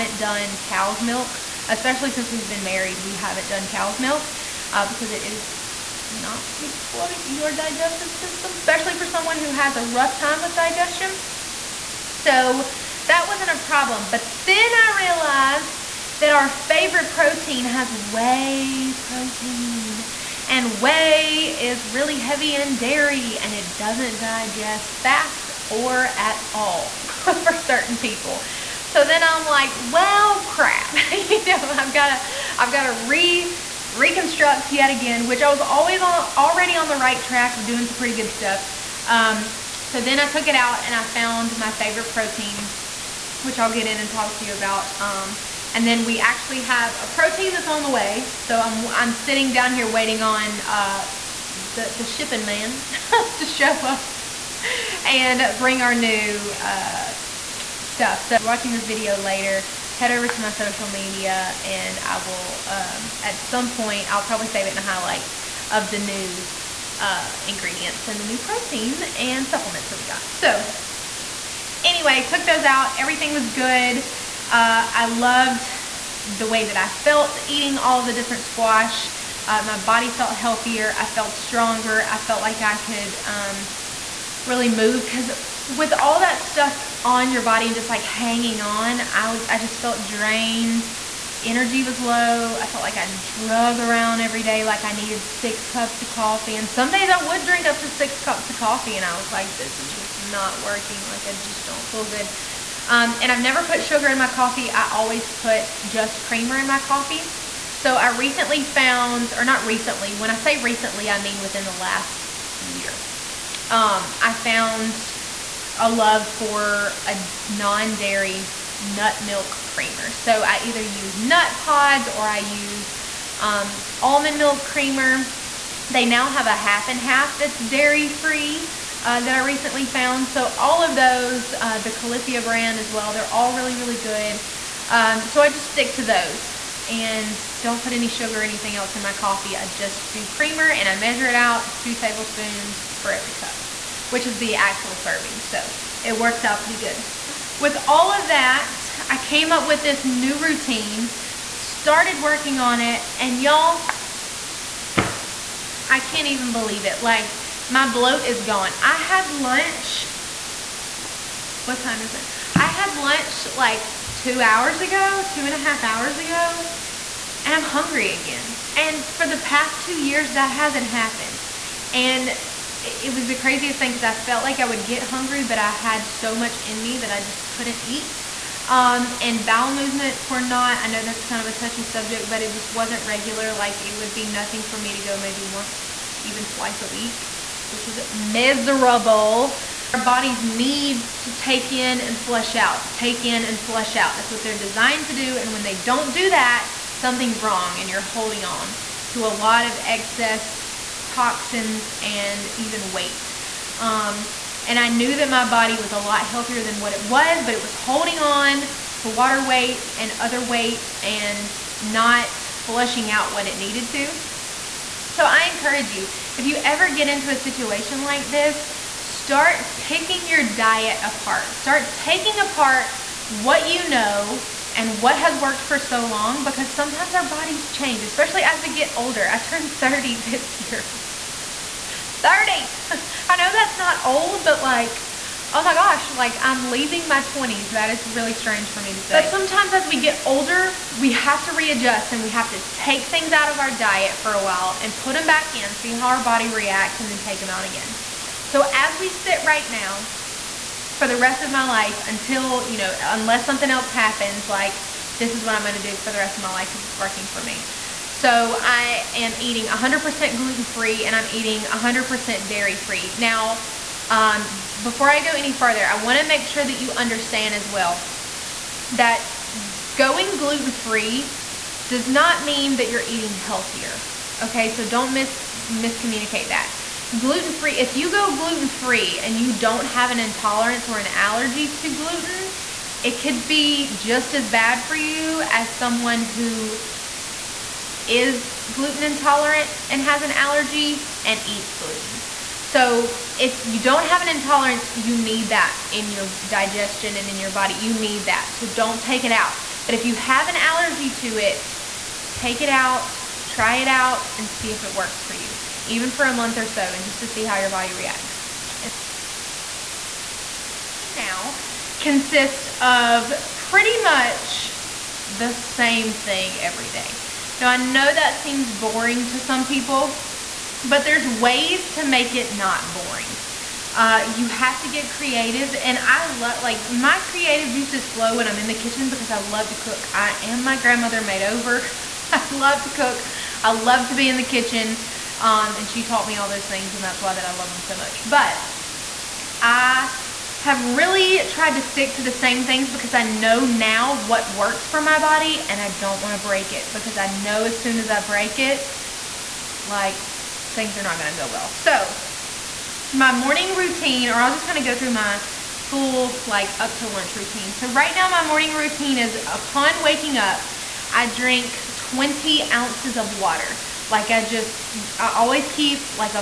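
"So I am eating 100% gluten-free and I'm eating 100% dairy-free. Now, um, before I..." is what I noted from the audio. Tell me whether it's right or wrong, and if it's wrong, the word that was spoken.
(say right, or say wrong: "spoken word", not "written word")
right.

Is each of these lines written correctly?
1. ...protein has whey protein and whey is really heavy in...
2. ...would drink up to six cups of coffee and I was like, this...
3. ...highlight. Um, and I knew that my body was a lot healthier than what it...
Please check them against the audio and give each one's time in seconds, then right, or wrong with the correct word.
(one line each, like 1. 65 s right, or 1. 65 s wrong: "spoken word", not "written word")
1. 17 s right
2. 97 s right
3. 202 s wrong: "weight", not "highlight".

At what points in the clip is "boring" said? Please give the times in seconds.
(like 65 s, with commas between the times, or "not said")
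318 s, 322 s.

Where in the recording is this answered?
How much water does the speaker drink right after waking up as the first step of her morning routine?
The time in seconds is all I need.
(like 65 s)
361 s.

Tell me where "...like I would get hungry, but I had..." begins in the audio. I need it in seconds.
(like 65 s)
174 s.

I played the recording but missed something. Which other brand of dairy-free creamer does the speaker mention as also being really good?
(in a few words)
Califia.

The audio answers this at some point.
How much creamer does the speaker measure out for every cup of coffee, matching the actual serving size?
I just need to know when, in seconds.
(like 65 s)
141 s.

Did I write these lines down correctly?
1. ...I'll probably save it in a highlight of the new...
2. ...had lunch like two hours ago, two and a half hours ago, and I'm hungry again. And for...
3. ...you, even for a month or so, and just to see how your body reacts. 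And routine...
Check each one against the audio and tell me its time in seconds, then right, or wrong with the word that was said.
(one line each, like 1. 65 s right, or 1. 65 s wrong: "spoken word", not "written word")
1. 64 s right
2. 162 s right
3. 305 s right.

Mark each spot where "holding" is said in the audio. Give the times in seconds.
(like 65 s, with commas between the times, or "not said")
198 s, 207 s.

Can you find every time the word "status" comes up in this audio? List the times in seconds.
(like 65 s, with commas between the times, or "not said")
not said.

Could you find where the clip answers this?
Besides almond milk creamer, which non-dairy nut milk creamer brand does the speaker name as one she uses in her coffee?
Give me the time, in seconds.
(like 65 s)
121 s.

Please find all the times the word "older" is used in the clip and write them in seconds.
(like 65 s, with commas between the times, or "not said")
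228 s, 240 s.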